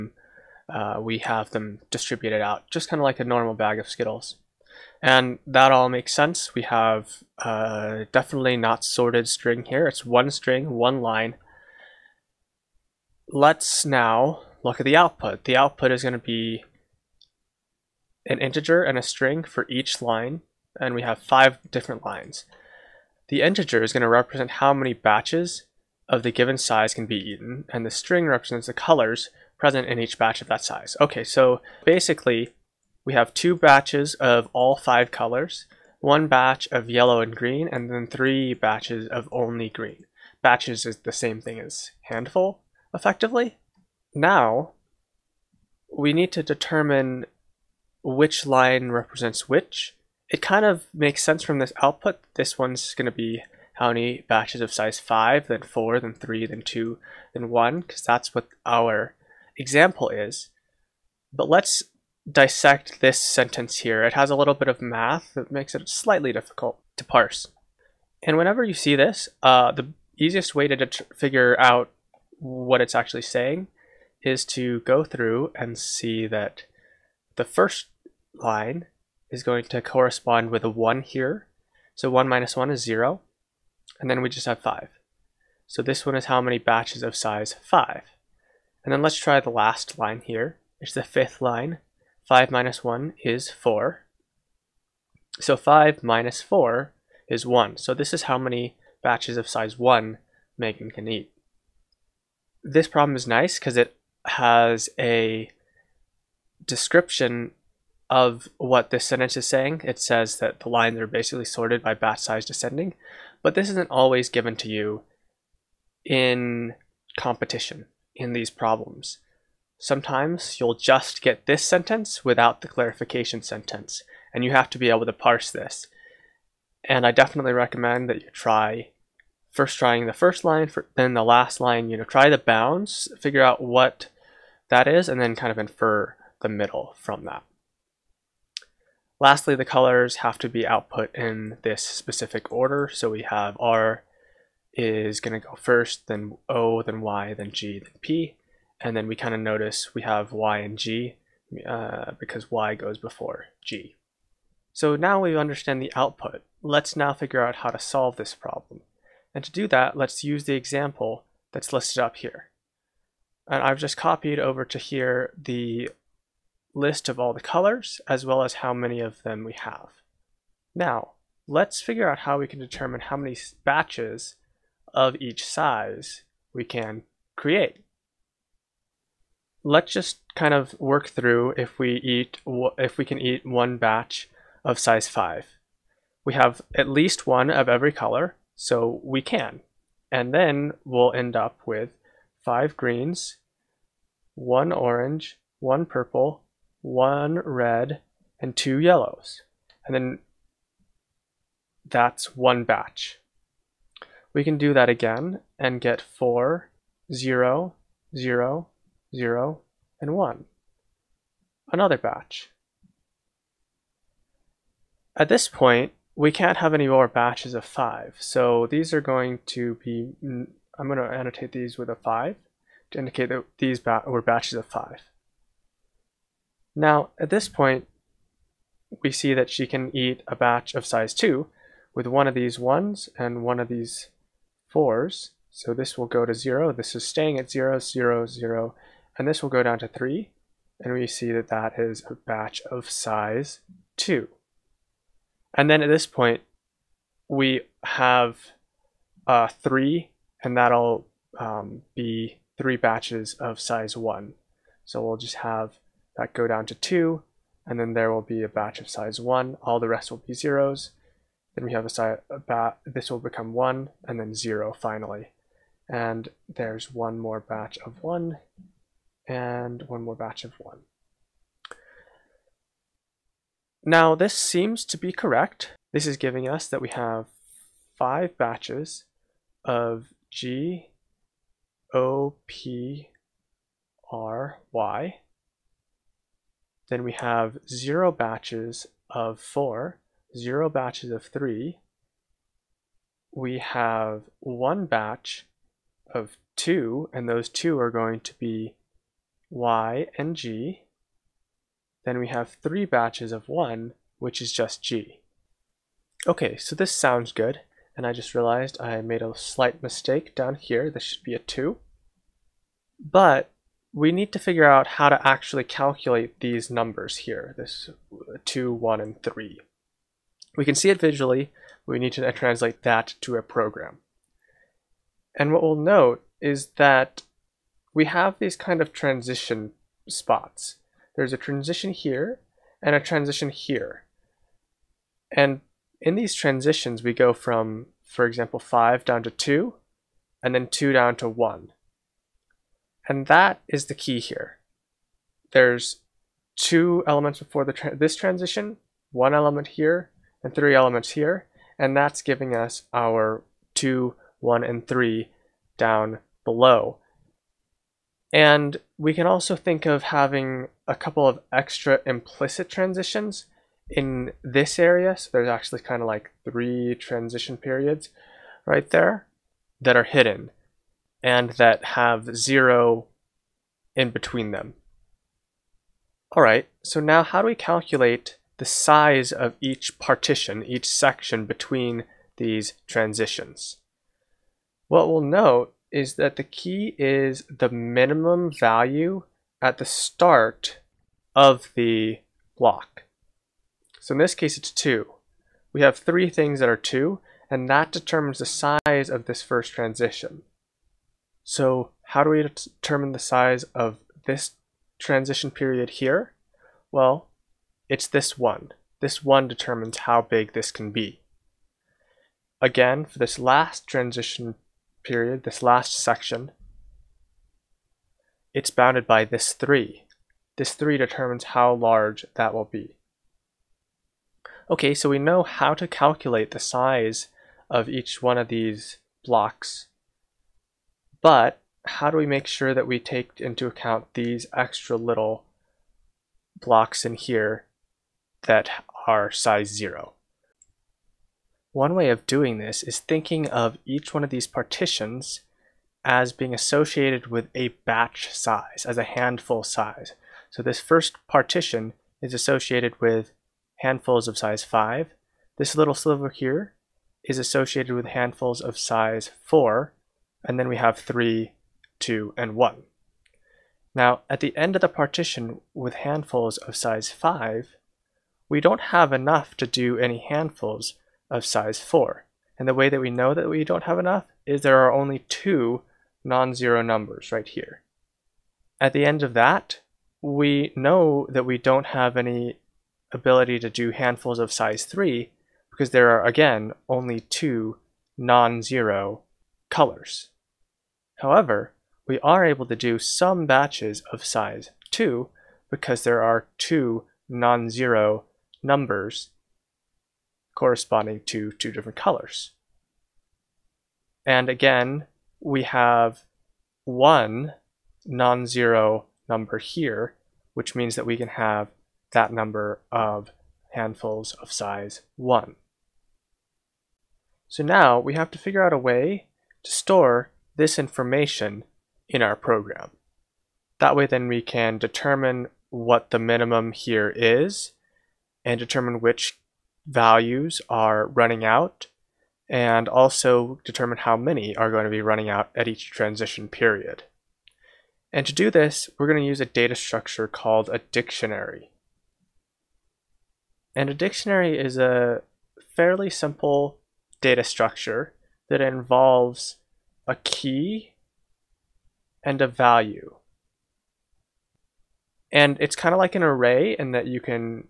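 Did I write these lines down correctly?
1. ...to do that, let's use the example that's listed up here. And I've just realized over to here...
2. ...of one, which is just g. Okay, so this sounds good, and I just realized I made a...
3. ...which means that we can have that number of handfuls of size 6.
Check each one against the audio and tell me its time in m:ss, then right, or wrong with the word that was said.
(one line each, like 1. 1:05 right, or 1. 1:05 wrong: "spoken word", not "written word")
1. 2:39 wrong: "copied", not "realized"
2. 5:03 right
3. 8:30 wrong: "1", not "6".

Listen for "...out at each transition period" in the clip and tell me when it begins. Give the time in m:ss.
8:55.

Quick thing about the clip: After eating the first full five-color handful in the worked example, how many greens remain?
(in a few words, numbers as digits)
5.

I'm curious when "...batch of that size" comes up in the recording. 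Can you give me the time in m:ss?
0:30.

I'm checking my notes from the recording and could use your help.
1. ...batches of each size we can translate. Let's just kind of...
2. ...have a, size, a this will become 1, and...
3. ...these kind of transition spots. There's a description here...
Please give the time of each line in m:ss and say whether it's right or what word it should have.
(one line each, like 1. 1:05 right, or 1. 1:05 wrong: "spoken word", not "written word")
1. 2:53 wrong: "create", not "translate"
2. 4:21 right
3. 5:28 wrong: "transition", not "description".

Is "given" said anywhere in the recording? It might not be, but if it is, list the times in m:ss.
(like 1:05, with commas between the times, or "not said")
0:26, 1:54.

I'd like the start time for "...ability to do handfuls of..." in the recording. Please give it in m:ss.
8:03.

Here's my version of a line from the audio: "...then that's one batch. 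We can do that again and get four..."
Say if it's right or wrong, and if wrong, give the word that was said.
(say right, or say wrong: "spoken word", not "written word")
right.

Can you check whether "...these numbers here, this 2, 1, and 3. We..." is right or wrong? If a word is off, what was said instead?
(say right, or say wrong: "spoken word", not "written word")
right.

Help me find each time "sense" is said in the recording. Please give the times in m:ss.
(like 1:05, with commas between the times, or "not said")
0:06, 0:51.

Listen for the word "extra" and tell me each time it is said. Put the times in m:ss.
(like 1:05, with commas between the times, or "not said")
6:01, 7:14.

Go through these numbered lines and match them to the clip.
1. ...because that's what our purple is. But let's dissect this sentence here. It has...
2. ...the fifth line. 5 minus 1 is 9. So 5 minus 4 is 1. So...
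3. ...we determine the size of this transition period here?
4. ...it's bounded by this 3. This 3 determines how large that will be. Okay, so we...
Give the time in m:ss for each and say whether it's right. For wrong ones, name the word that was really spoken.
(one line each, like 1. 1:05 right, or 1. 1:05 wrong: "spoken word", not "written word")
1. 0:57 wrong: "example", not "purple"
2. 1:30 wrong: "4", not "9"
3. 6:42 right
4. 6:58 right.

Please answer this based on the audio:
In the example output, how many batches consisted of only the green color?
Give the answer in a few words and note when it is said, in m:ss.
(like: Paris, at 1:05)
3, at 0:38.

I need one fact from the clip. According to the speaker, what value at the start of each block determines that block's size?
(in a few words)
the minimum value.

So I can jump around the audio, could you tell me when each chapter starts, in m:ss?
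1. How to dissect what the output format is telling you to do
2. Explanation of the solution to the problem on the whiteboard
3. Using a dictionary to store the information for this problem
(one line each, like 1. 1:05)
1. 0:43
2. 2:36
3. 8:36.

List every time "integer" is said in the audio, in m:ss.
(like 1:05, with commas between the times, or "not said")
0:18, 0:23.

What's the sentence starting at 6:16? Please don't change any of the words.
All right, so now how do we calculate the size of each partition, each section between these transitions?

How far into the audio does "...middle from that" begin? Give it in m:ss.
2:16.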